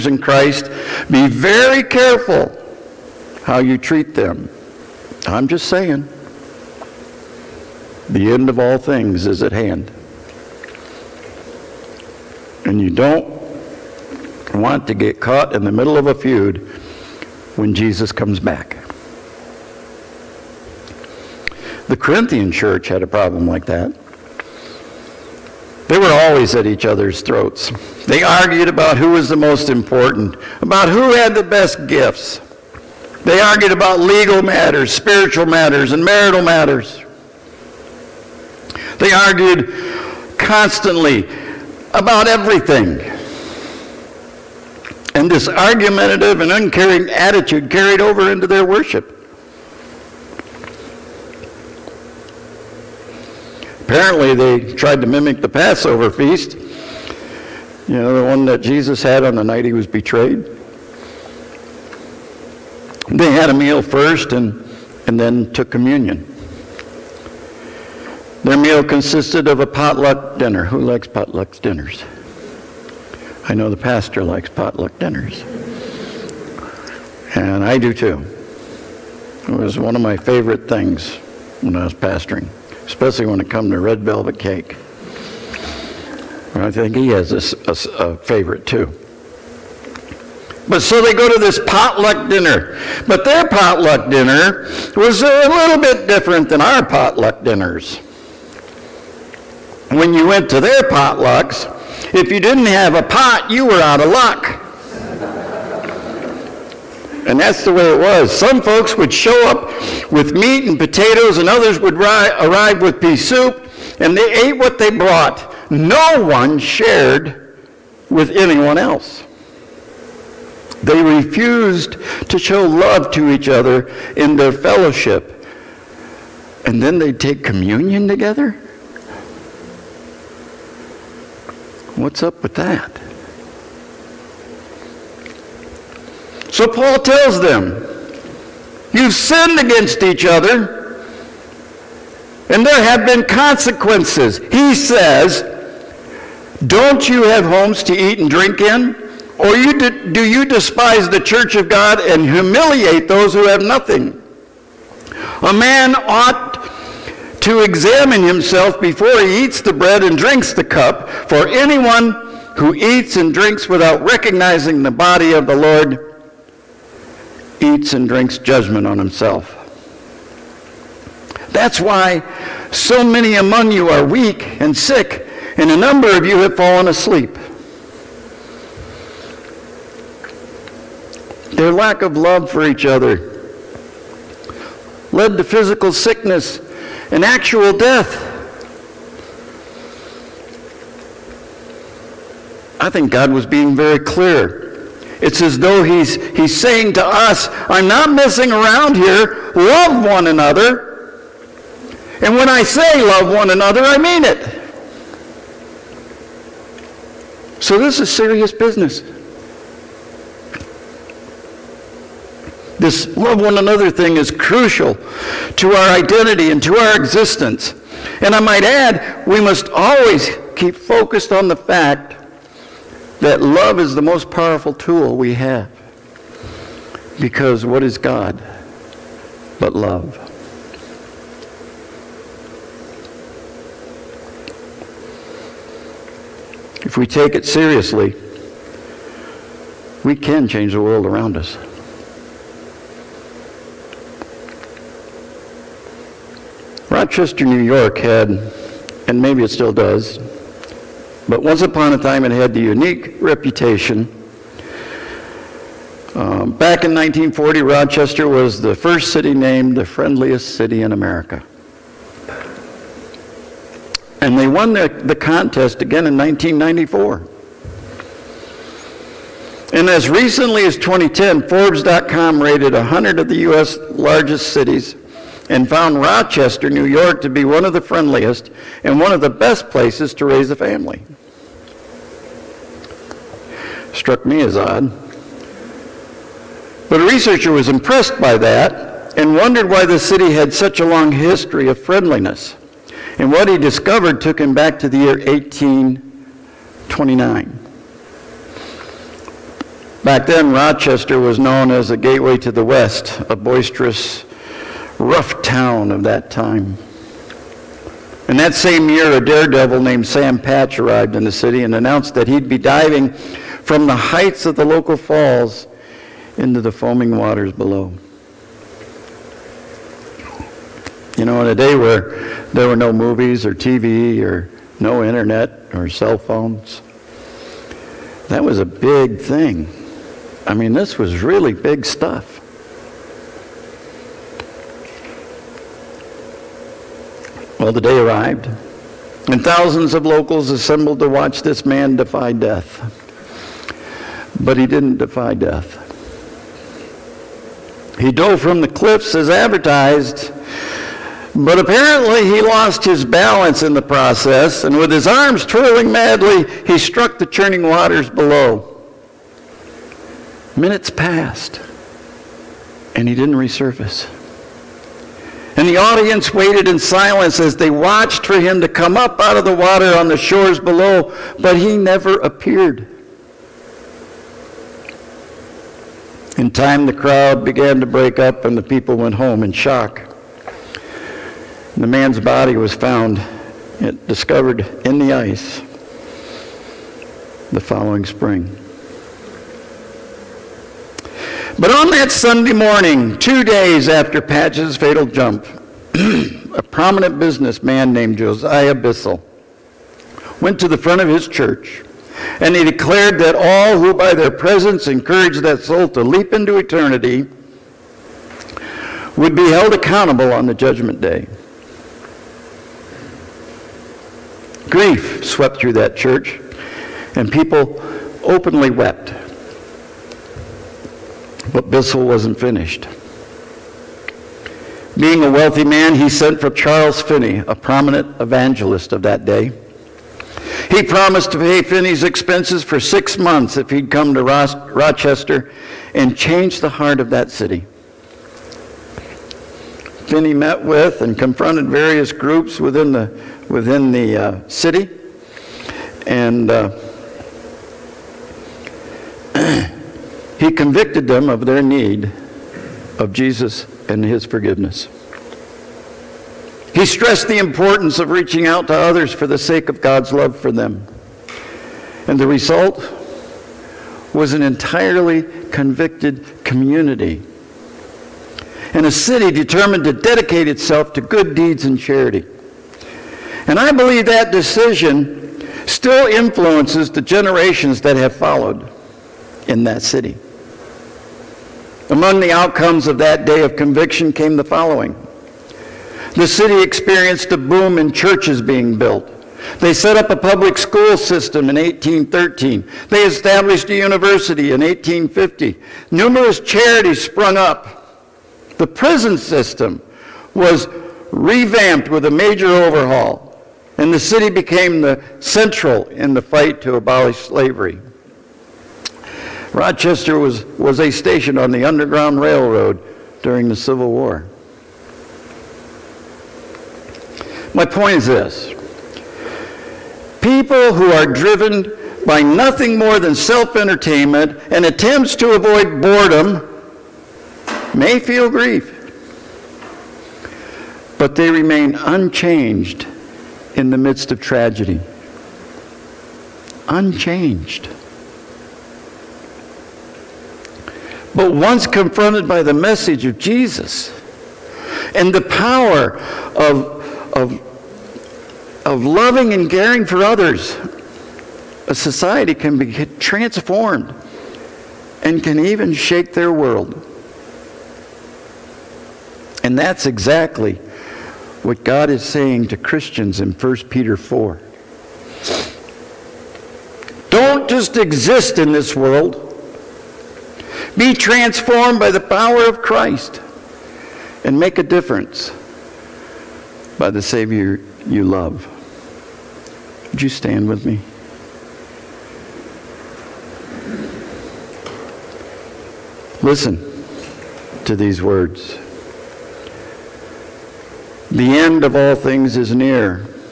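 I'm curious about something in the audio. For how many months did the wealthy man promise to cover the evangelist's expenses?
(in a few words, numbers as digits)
6.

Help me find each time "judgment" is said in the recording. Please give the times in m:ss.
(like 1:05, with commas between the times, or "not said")
2:48, 6:50.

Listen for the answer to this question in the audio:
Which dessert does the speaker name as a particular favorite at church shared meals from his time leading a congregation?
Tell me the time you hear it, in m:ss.
1:23.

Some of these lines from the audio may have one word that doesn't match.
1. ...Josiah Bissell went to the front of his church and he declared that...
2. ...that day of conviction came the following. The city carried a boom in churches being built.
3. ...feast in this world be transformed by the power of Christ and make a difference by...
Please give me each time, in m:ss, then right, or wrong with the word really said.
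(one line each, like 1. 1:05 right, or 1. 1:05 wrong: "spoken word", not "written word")
1. 6:38 right
2. 8:02 wrong: "experienced", not "carried"
3. 9:27 wrong: "exist", not "feast".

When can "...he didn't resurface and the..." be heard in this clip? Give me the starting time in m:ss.
6:03.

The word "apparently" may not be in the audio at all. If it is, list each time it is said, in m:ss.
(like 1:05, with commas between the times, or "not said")
0:53, 5:51.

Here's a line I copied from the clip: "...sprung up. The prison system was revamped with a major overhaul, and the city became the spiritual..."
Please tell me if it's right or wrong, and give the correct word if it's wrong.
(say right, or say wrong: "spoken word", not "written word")
wrong: "central", not "spiritual".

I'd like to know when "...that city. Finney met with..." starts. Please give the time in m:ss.
7:17.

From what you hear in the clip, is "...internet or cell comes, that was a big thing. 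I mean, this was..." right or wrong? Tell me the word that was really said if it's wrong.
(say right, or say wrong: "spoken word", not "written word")
wrong: "phones", not "comes".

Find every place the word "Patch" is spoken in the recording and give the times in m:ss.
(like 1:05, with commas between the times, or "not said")
5:10, 6:34.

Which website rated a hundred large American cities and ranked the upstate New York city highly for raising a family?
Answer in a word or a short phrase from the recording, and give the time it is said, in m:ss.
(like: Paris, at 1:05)
Forbes.com, at 4:31.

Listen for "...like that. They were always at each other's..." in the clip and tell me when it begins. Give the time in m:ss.
0:23.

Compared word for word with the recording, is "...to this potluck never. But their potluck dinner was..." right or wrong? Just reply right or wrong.
wrong.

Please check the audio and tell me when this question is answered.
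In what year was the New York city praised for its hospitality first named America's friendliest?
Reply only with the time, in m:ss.
4:16.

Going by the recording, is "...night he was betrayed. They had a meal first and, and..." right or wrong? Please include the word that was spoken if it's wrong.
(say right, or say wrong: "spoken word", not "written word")
right.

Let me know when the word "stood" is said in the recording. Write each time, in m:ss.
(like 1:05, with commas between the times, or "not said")
not said.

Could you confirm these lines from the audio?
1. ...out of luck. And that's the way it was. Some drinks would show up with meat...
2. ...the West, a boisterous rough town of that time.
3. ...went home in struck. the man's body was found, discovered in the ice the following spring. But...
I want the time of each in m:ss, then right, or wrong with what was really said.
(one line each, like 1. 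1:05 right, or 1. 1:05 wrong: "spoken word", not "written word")
1. 1:43 wrong: "folks", not "drinks"
2. 5:02 right
3. 6:18 wrong: "shock", not "struck".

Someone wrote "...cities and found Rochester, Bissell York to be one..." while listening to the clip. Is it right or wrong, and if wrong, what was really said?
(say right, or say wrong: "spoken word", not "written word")
wrong: "New", not "Bissell".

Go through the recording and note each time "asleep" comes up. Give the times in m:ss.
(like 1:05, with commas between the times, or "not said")
2:56.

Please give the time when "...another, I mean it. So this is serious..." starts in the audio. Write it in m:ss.
3:23.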